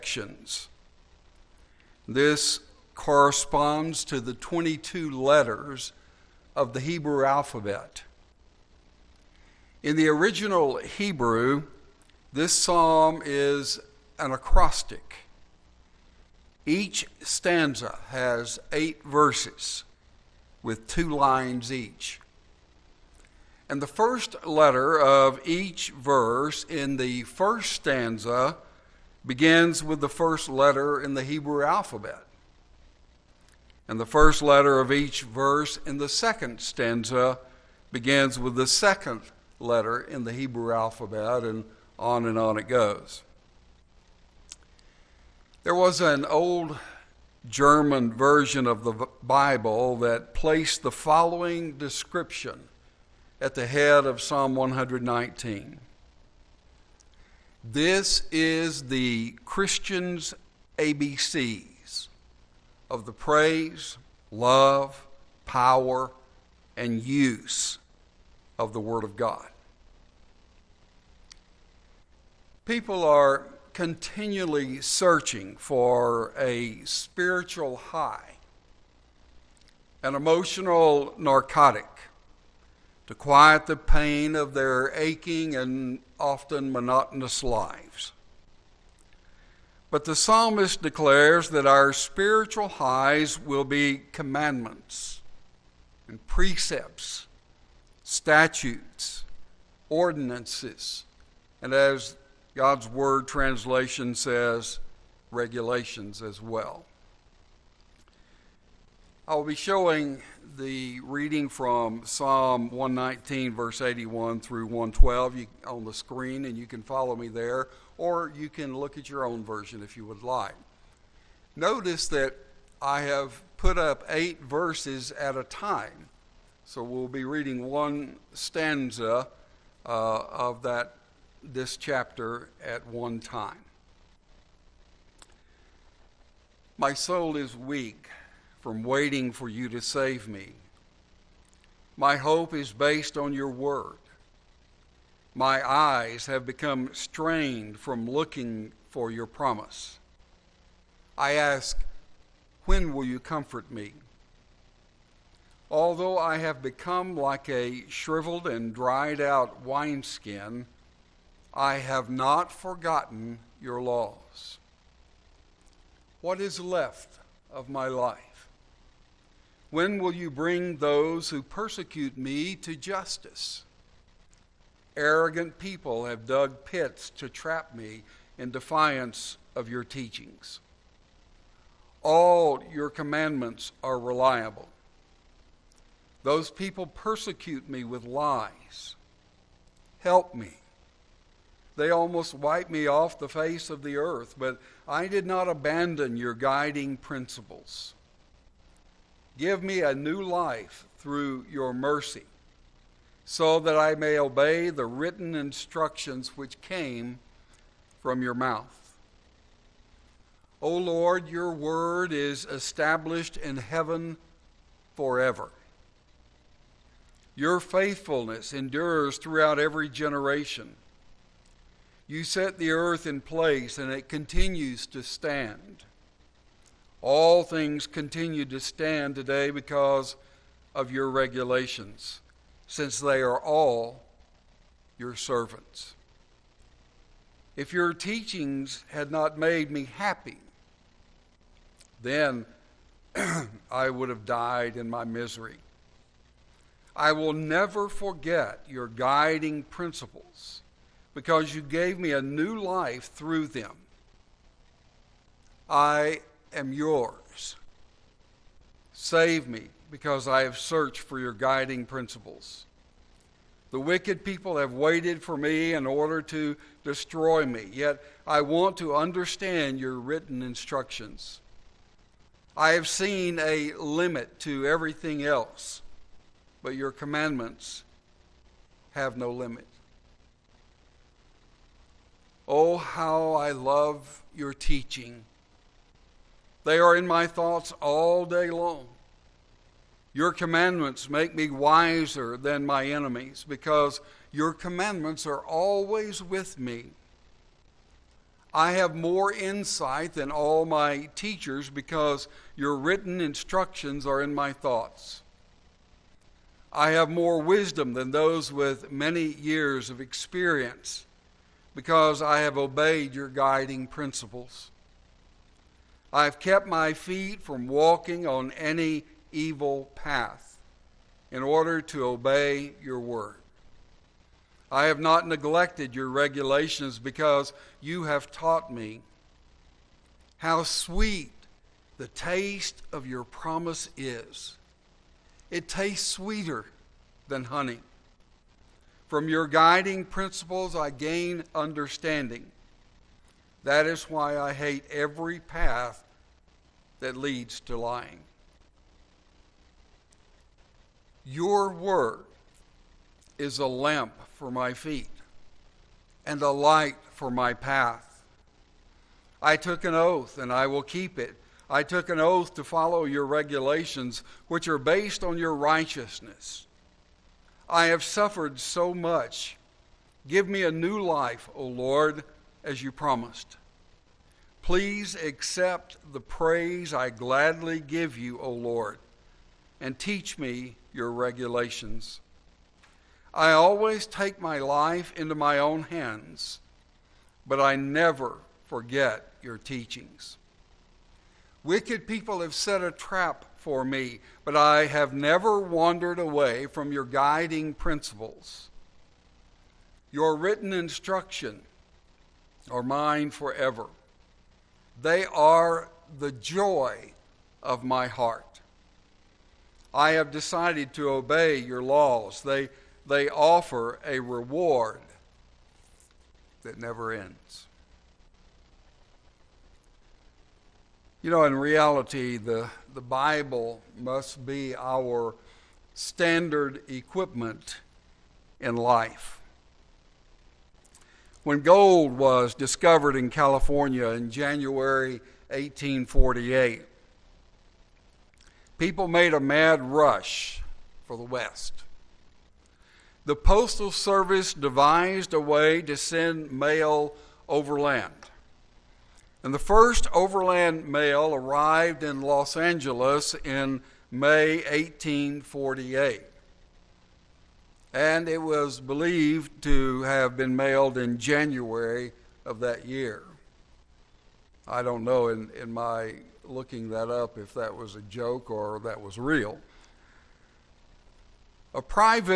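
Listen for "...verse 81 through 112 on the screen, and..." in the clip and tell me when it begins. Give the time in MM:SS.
01:53.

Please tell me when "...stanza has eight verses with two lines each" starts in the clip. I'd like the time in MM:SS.
00:17.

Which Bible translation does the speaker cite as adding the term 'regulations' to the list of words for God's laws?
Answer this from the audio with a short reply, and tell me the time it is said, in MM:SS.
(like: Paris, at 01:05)
God's Word translation, at 01:42.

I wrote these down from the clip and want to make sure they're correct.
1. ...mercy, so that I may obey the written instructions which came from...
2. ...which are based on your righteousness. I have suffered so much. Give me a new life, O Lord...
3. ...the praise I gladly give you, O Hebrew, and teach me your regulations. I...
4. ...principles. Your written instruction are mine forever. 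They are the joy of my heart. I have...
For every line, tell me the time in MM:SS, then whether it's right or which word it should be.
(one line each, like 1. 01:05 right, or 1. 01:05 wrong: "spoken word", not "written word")
1. 03:21 right
2. 06:04 right
3. 06:16 wrong: "Lord", not "Hebrew"
4. 06:37 right.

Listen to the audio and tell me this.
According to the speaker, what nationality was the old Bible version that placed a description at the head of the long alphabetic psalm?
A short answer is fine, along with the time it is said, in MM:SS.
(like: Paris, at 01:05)
German, at 00:47.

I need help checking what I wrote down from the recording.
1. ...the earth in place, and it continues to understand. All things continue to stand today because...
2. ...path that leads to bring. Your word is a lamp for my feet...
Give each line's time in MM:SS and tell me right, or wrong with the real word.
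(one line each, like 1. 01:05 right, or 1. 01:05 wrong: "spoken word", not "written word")
1. 03:42 wrong: "stand", not "understand"
2. 05:45 wrong: "lying", not "bring".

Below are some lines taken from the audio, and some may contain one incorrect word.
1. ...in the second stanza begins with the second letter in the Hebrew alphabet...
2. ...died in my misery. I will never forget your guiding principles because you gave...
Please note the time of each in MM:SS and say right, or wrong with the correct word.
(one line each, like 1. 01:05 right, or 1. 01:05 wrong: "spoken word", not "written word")
1. 00:35 right
2. 04:04 right.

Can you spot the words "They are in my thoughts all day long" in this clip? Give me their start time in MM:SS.
04:46.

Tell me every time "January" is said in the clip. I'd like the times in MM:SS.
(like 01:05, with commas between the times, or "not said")
07:14, 07:41.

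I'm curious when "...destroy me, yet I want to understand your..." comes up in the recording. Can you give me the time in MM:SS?
04:26.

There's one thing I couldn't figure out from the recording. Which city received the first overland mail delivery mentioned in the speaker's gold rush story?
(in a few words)
Los Angeles.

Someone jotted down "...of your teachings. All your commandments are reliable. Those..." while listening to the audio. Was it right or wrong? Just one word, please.
right.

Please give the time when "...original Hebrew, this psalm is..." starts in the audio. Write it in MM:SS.
00:10.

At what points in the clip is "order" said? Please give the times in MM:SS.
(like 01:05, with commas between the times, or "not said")
04:25, 05:21.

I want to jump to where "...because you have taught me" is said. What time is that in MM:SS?
05:26.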